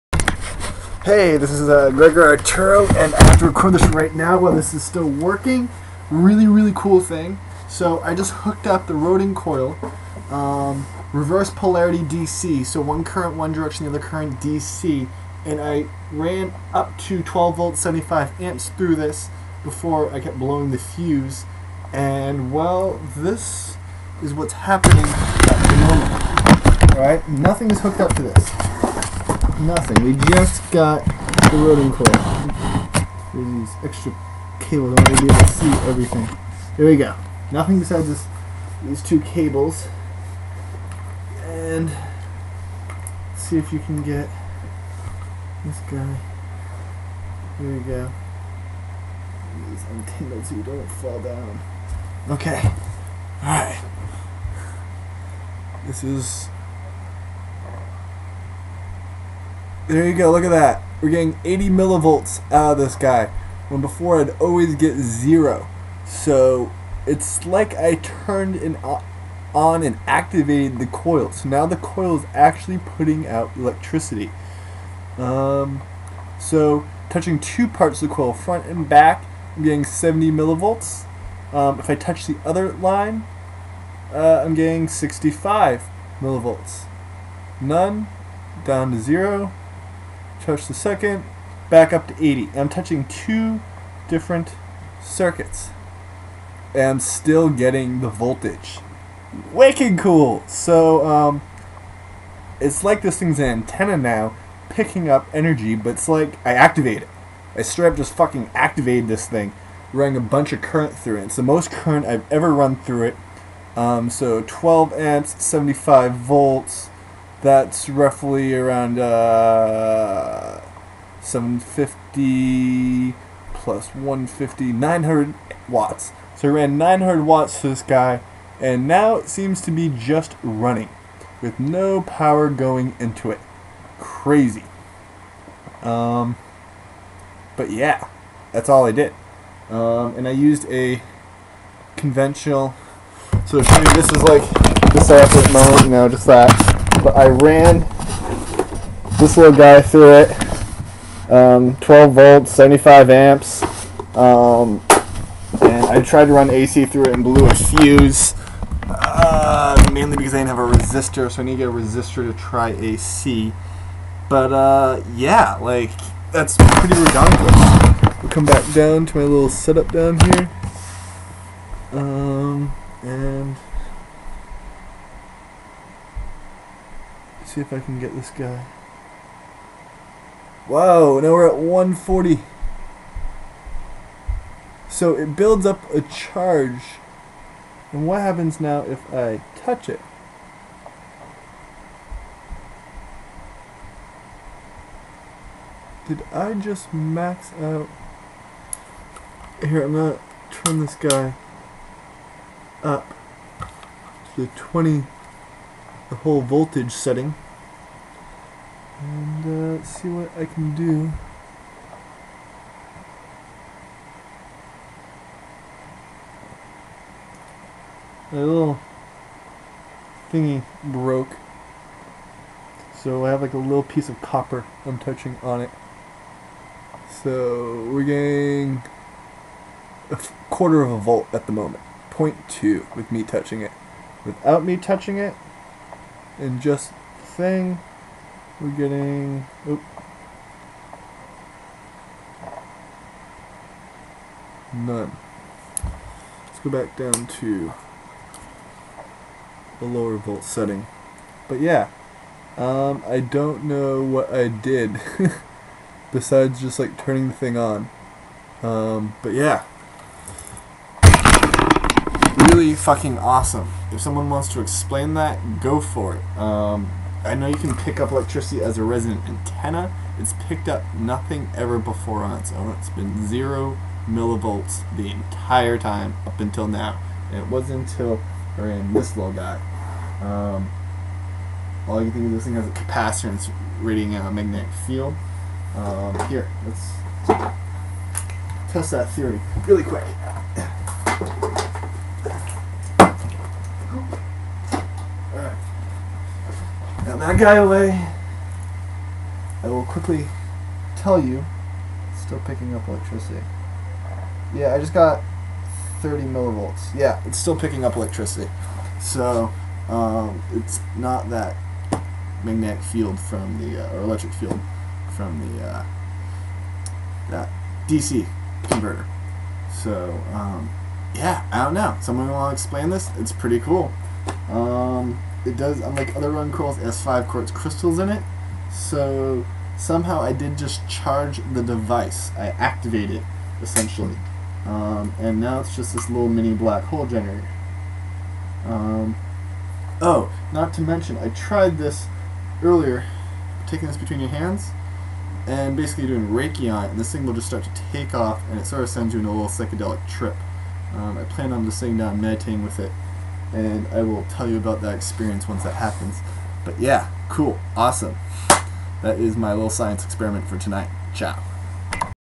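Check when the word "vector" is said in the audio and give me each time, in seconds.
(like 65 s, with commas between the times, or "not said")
not said.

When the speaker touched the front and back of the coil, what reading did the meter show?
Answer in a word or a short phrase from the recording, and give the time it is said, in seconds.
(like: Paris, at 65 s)
70 millivolts, at 79 s.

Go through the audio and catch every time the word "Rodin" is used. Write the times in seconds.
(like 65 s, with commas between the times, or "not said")
8 s, 31 s, 326 s.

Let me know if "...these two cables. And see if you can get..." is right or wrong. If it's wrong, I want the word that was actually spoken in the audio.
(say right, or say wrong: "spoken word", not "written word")
right.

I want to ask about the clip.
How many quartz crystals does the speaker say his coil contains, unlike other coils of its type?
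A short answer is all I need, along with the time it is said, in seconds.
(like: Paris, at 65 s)
5, at 327 s.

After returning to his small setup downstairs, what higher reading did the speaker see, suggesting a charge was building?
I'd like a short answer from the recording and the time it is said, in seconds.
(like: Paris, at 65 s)
140, at 181 s.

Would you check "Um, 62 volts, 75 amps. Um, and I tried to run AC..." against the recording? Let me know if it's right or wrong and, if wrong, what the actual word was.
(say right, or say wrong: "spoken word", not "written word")
wrong: "12", not "62".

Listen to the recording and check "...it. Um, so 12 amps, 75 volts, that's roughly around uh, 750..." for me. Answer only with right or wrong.
right.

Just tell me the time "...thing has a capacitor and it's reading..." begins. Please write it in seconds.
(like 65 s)
282 s.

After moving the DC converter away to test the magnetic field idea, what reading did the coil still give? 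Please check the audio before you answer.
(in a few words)
30 millivolts.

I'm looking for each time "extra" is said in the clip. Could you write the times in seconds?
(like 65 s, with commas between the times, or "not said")
33 s.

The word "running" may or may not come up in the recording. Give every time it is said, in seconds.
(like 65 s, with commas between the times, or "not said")
109 s, 130 s.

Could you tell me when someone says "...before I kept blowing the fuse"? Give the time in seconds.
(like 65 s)
19 s.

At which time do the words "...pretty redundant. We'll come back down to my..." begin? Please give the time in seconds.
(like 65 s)
166 s.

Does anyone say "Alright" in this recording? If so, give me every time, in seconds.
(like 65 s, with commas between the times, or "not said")
26 s, 53 s.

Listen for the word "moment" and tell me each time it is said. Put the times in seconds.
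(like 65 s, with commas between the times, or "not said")
26 s, 145 s, 231 s.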